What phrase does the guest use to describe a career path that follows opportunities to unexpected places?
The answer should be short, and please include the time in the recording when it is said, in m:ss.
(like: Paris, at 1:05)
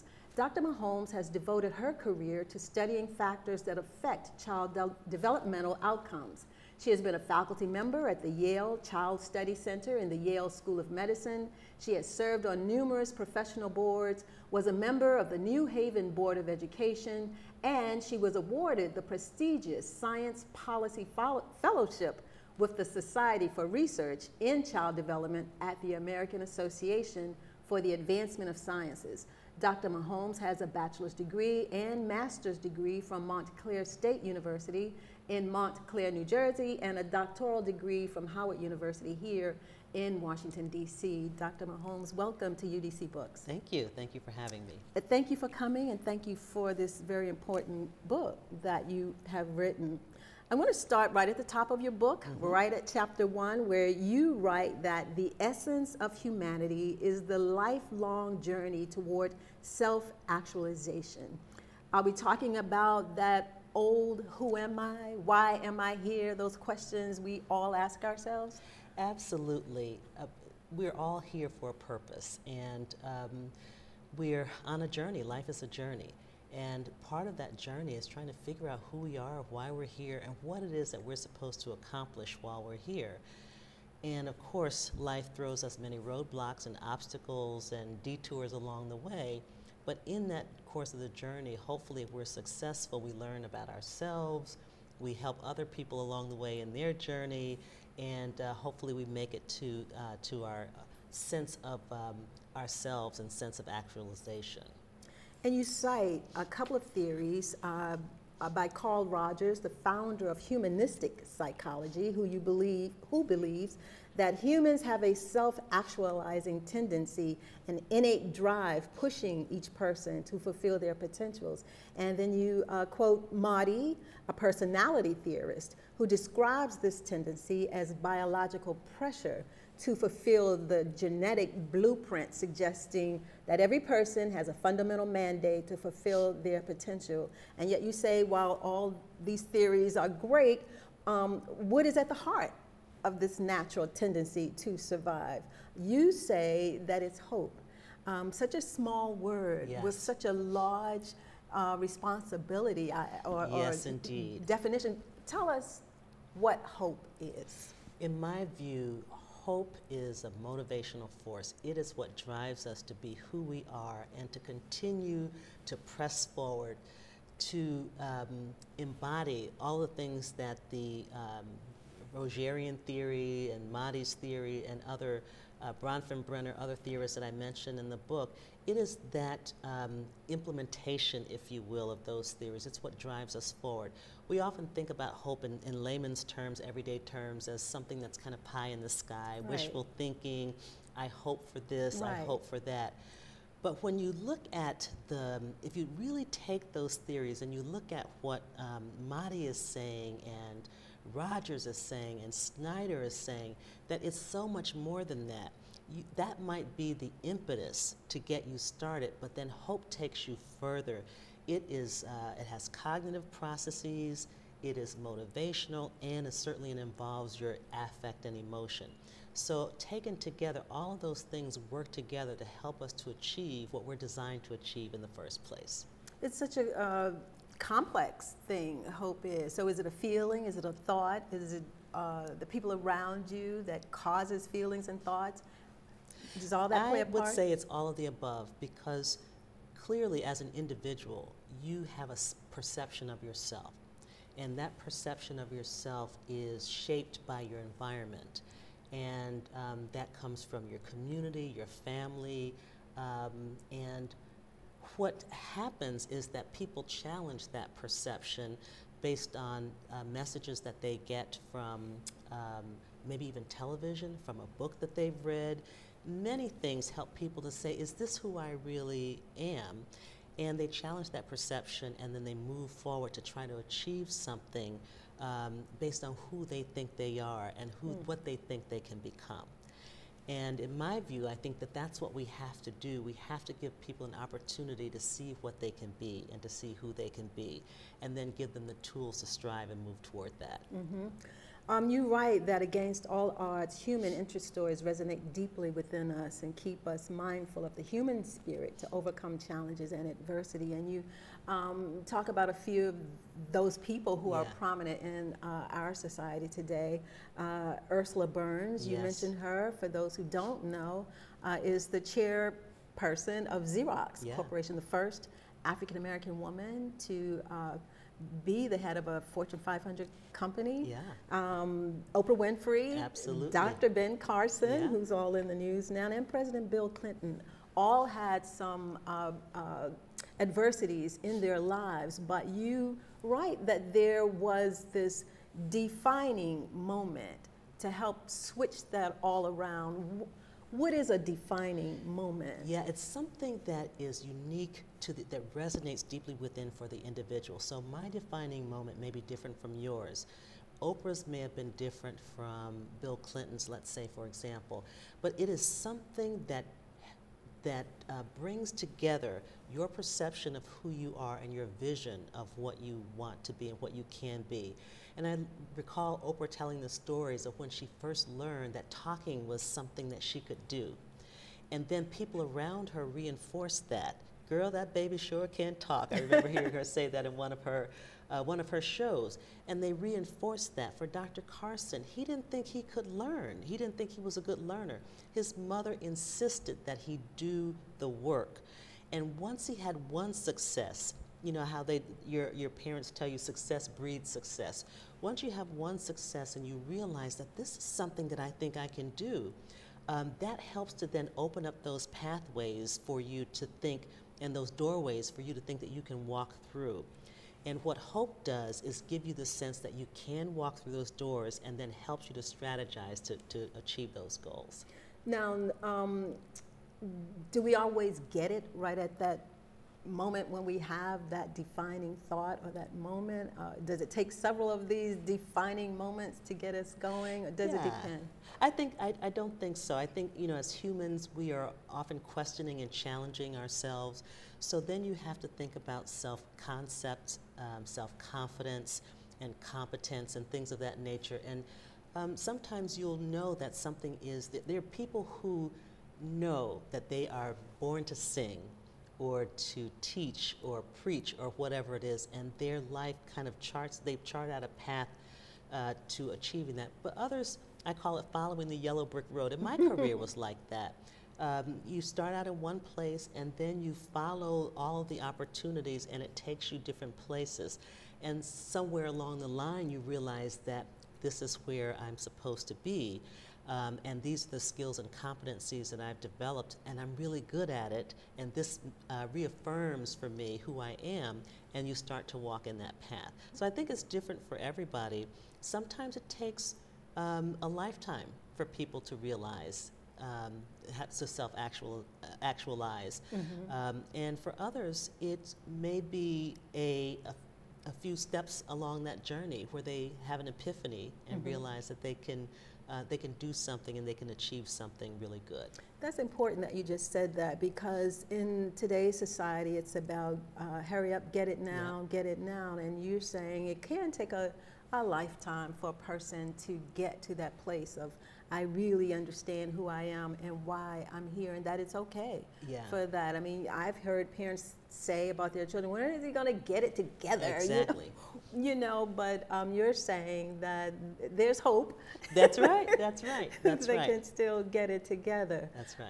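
following the yellow brick road, at 7:38.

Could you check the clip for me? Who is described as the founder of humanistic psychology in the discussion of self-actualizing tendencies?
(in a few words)
Carl Rogers.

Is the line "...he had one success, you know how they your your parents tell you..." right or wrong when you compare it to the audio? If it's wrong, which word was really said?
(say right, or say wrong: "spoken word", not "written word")
right.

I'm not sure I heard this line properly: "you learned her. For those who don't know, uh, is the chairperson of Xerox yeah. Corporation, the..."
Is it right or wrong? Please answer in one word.
wrong.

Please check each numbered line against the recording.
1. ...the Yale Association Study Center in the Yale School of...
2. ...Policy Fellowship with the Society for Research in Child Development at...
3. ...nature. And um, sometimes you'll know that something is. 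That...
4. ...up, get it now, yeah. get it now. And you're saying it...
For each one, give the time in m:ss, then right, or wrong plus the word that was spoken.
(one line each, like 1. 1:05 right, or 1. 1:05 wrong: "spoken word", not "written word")
1. 0:08 wrong: "Child", not "Association"
2. 0:20 right
3. 7:20 right
4. 8:31 right.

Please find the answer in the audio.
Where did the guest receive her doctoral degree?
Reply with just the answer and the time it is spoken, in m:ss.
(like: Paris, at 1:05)
Howard University, at 0:38.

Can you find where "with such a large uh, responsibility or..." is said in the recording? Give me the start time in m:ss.
2:29.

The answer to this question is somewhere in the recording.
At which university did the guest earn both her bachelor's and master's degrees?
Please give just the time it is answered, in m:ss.
0:33.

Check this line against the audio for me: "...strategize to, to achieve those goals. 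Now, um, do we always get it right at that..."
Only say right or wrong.
right.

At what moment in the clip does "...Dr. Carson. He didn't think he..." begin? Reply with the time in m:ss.
6:21.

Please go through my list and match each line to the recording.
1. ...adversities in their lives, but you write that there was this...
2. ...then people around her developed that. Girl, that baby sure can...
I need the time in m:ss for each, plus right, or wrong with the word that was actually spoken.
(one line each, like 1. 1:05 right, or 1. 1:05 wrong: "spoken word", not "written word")
1. 5:30 right
2. 6:11 wrong: "reinforced", not "developed".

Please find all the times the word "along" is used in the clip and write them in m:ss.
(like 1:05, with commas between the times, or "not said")
1:28, 1:36, 7:49, 8:18.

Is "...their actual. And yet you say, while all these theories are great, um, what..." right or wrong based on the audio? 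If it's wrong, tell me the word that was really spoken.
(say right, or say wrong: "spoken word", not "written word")
wrong: "potential", not "actual".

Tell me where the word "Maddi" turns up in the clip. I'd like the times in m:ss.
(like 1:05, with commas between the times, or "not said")
2:03, 2:53.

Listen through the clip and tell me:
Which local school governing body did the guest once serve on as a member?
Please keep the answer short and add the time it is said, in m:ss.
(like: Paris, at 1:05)
New Haven Board of Education, at 0:15.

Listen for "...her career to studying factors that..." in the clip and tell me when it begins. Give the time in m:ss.
0:01.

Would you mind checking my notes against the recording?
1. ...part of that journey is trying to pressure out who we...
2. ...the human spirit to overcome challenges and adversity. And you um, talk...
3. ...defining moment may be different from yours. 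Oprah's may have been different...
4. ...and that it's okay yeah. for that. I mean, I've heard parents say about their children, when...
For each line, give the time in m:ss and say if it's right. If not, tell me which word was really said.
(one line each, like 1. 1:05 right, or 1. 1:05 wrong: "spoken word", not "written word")
1. 1:17 wrong: "figure", not "pressure"
2. 4:57 right
3. 5:48 right
4. 8:41 right.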